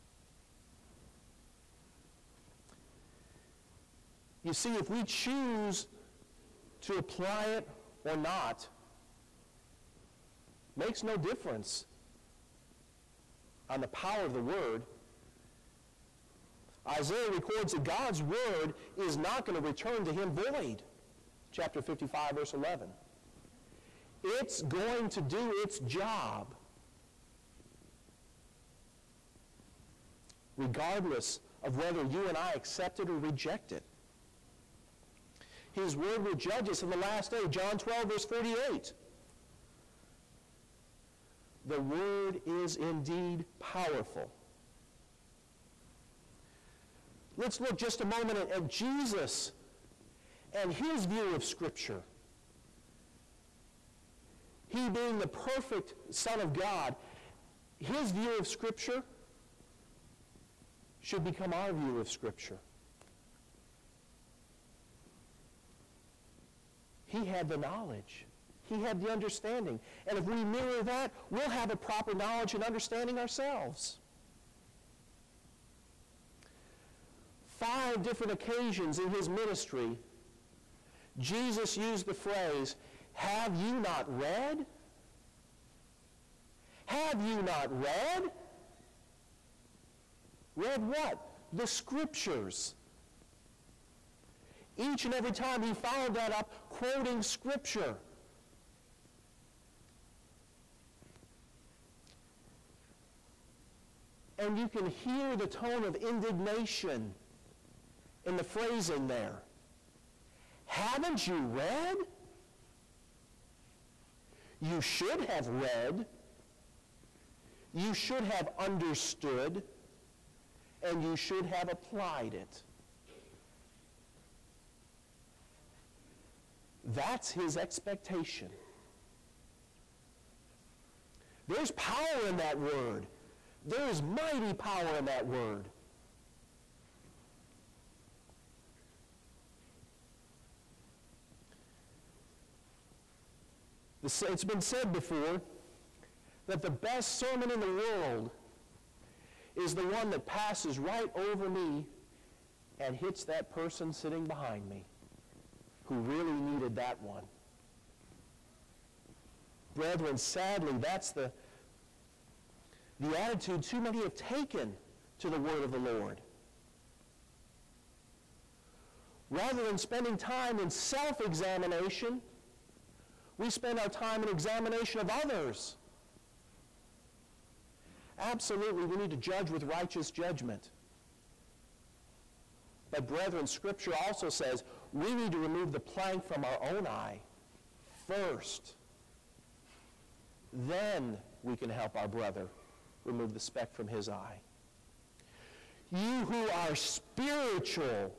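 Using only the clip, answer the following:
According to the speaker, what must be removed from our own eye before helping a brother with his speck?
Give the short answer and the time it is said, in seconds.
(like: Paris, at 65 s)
the plank, at 185 s.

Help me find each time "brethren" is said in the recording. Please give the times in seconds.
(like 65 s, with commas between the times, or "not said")
159 s, 183 s.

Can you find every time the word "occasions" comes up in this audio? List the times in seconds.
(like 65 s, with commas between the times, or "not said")
78 s.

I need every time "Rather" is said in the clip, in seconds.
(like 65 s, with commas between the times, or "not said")
169 s.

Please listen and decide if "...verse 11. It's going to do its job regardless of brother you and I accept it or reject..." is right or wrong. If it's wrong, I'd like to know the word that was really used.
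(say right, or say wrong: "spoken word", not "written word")
wrong: "whether", not "brother".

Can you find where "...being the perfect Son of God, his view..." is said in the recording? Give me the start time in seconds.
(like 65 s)
54 s.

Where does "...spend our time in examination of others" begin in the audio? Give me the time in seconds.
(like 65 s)
173 s.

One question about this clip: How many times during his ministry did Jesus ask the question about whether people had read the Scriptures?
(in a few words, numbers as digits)
5.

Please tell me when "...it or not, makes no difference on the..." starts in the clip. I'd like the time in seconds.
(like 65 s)
7 s.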